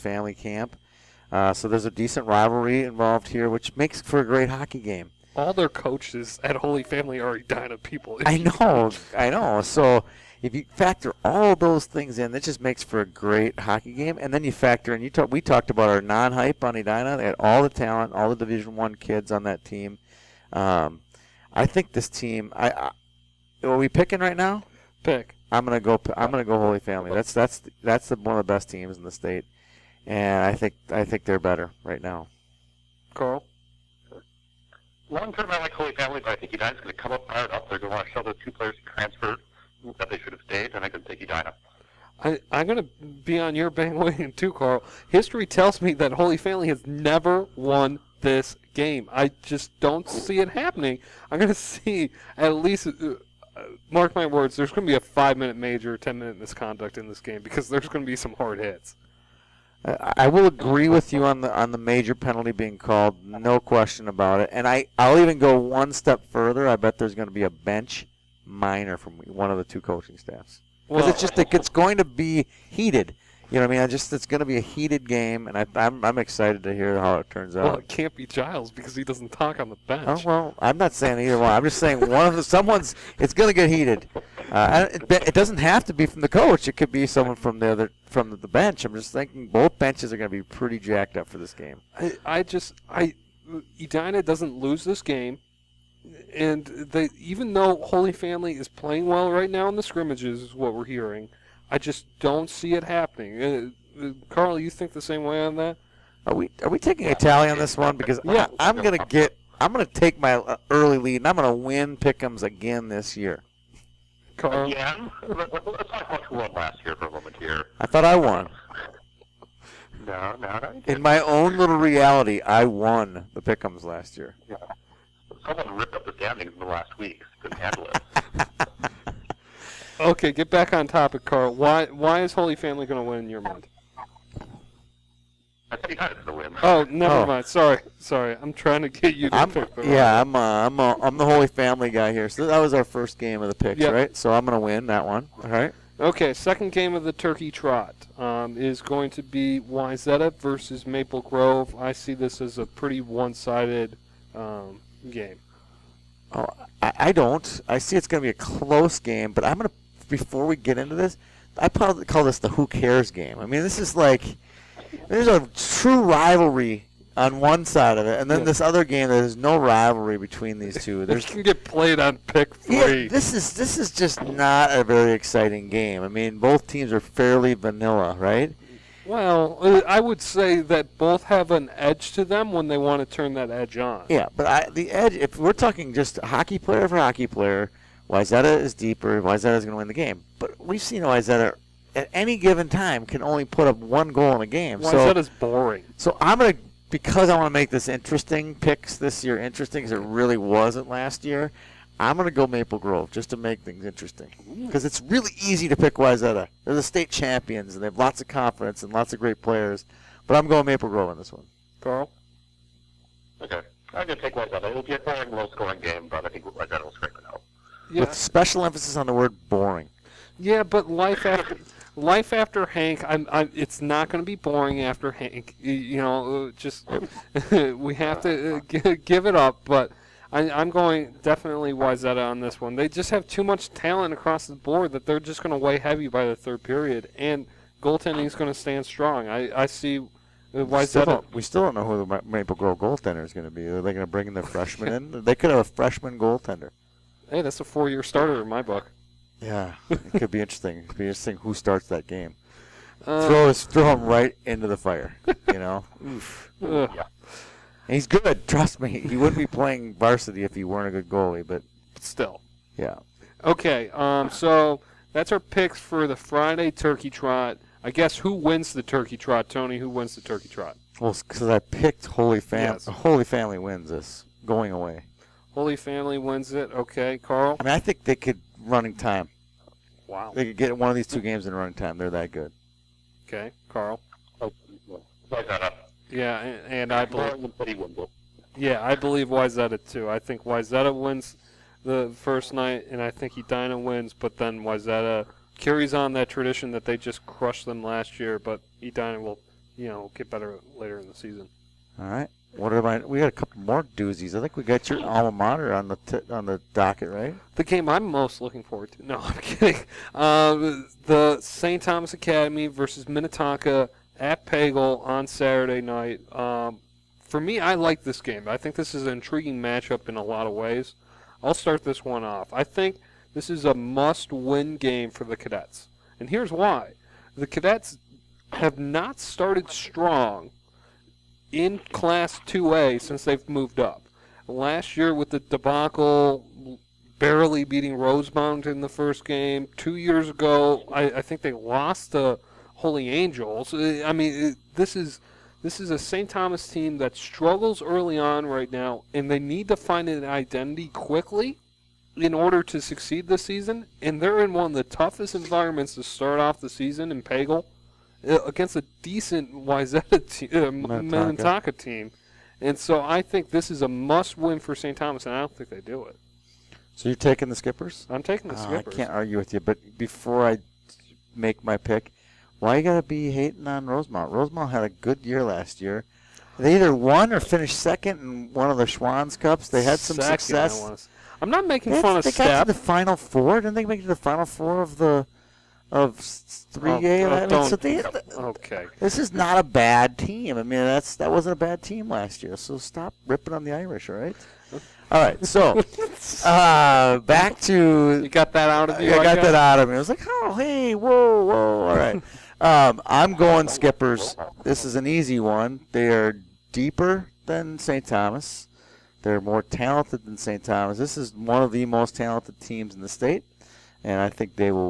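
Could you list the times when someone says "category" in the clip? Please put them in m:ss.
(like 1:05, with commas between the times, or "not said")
not said.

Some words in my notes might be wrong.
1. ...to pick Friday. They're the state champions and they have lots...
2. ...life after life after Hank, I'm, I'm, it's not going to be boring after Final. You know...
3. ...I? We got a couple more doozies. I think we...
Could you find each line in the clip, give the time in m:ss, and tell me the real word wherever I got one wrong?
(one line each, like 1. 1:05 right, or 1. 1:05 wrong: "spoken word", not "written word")
1. 3:25 wrong: "Wayzata", not "Friday"
2. 3:40 wrong: "Hank", not "Final"
3. 5:02 right.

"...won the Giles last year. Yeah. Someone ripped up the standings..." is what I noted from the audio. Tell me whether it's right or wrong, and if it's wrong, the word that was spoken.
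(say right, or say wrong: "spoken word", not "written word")
wrong: "Pickums", not "Giles".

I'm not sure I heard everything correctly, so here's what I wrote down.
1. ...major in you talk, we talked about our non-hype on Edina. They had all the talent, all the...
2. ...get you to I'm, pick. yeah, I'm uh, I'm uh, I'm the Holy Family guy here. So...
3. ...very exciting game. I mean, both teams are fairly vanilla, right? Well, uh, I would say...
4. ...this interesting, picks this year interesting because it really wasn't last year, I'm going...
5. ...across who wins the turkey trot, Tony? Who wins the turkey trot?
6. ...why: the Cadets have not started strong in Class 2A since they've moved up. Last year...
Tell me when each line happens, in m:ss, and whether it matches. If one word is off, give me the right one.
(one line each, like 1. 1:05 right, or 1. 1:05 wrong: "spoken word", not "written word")
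1. 0:14 wrong: "factor", not "major"
2. 2:18 right
3. 2:54 right
4. 3:17 right
5. 4:27 wrong: "guess", not "across"
6. 5:26 right.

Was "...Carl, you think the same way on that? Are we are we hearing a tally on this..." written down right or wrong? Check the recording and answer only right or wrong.
wrong.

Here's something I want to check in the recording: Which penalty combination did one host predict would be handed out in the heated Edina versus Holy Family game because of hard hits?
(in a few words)
5 minute major, 10 minute misconduct.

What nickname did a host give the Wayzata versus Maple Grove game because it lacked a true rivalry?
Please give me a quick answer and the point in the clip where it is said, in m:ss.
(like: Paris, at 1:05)
the who cares game, at 2:42.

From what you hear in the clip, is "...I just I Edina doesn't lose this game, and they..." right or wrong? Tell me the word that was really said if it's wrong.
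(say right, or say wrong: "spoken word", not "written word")
right.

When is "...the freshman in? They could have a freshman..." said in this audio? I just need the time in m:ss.
4:04.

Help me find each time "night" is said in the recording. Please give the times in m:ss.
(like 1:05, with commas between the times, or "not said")
4:52, 5:15.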